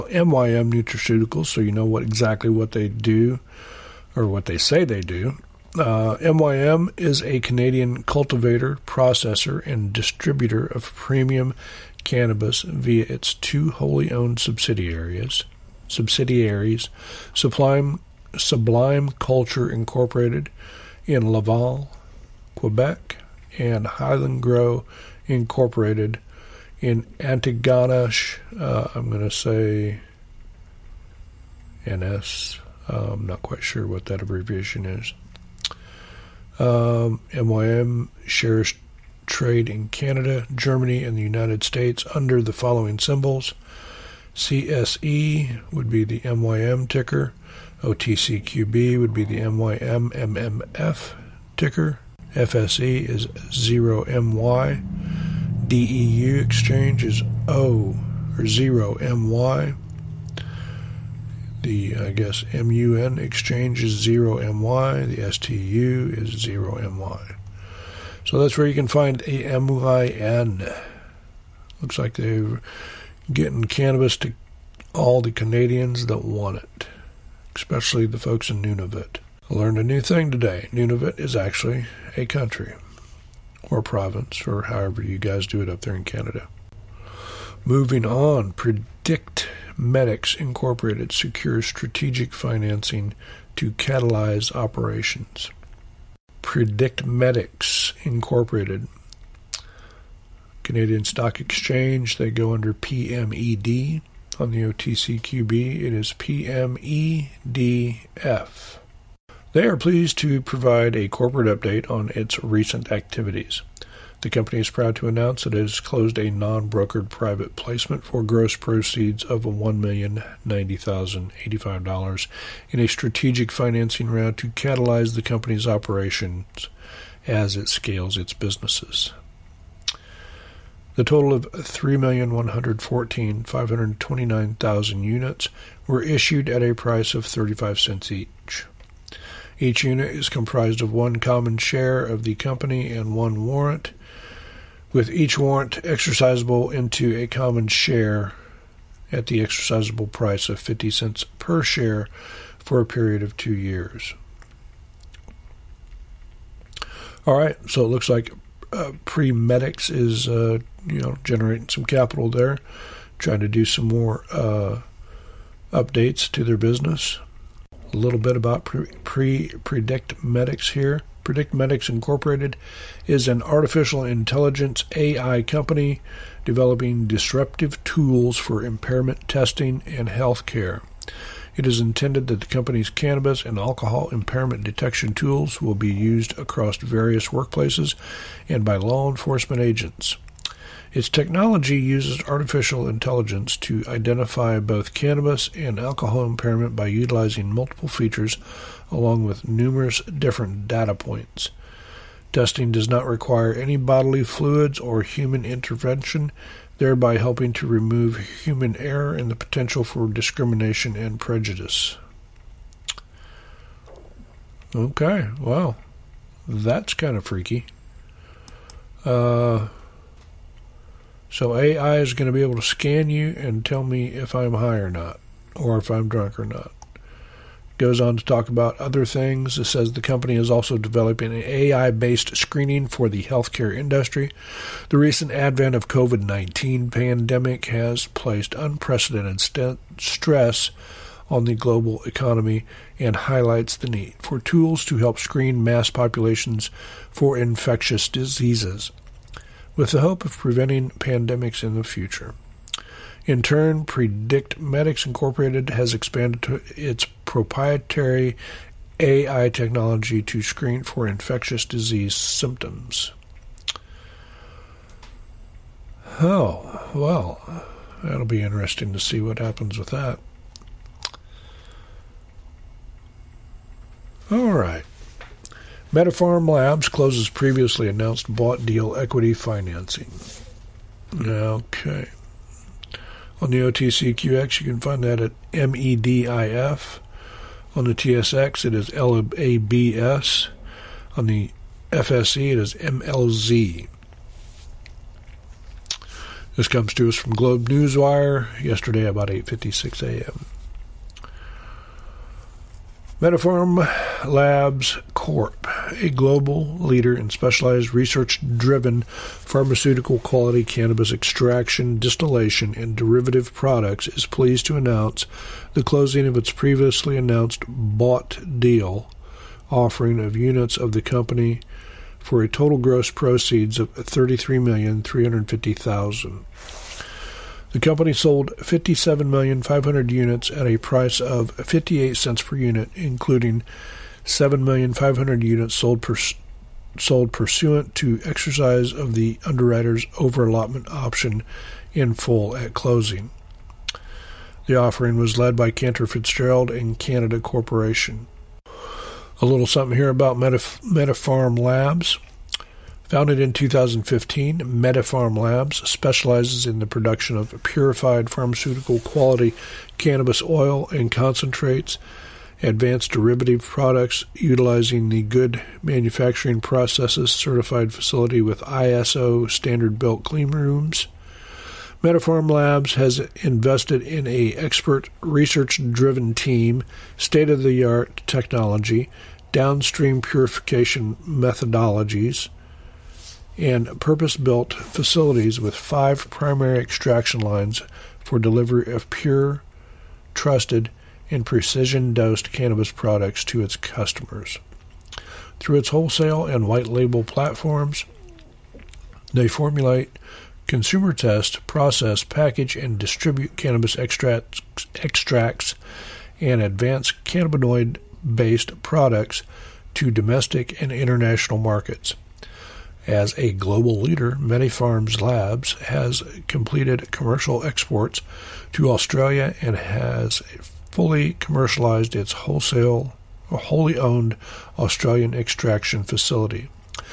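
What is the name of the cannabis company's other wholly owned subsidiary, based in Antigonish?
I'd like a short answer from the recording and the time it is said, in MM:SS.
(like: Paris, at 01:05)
Highland Grow, at 00:23.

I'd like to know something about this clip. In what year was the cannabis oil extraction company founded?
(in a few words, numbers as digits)
2015.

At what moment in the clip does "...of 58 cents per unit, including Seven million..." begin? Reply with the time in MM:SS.
05:31.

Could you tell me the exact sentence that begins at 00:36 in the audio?
Um, MYM shares trade in Canada, Germany, and the United States under the following symbols.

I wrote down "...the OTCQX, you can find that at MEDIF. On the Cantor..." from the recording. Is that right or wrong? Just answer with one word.
wrong.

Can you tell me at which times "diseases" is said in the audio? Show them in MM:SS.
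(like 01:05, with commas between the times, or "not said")
04:08, 04:21.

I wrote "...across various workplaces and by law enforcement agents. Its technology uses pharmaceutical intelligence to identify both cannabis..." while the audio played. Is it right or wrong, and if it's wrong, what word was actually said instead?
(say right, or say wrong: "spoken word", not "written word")
wrong: "artificial", not "pharmaceutical".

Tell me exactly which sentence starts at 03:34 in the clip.
Okay, well, That's kind of freaky.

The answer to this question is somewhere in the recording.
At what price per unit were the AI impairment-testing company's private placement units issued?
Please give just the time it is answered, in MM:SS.
02:17.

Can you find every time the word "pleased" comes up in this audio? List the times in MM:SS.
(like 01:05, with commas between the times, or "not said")
01:49, 05:14.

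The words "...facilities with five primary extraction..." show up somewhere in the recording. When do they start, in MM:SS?
06:24.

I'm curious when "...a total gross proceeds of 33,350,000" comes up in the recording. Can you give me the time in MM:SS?
05:22.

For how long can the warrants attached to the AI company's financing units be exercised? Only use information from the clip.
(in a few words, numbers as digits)
2 years.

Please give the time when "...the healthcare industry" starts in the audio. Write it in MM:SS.
03:53.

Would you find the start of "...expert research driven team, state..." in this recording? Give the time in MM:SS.
06:14.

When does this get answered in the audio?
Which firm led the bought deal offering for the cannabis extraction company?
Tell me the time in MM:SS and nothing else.
05:45.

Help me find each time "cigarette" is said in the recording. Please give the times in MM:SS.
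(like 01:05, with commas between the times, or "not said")
not said.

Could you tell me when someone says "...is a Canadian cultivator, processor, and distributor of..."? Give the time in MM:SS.
00:06.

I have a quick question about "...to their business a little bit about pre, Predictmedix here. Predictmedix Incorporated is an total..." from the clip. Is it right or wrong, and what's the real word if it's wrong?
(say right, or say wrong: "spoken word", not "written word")
wrong: "artificial", not "total".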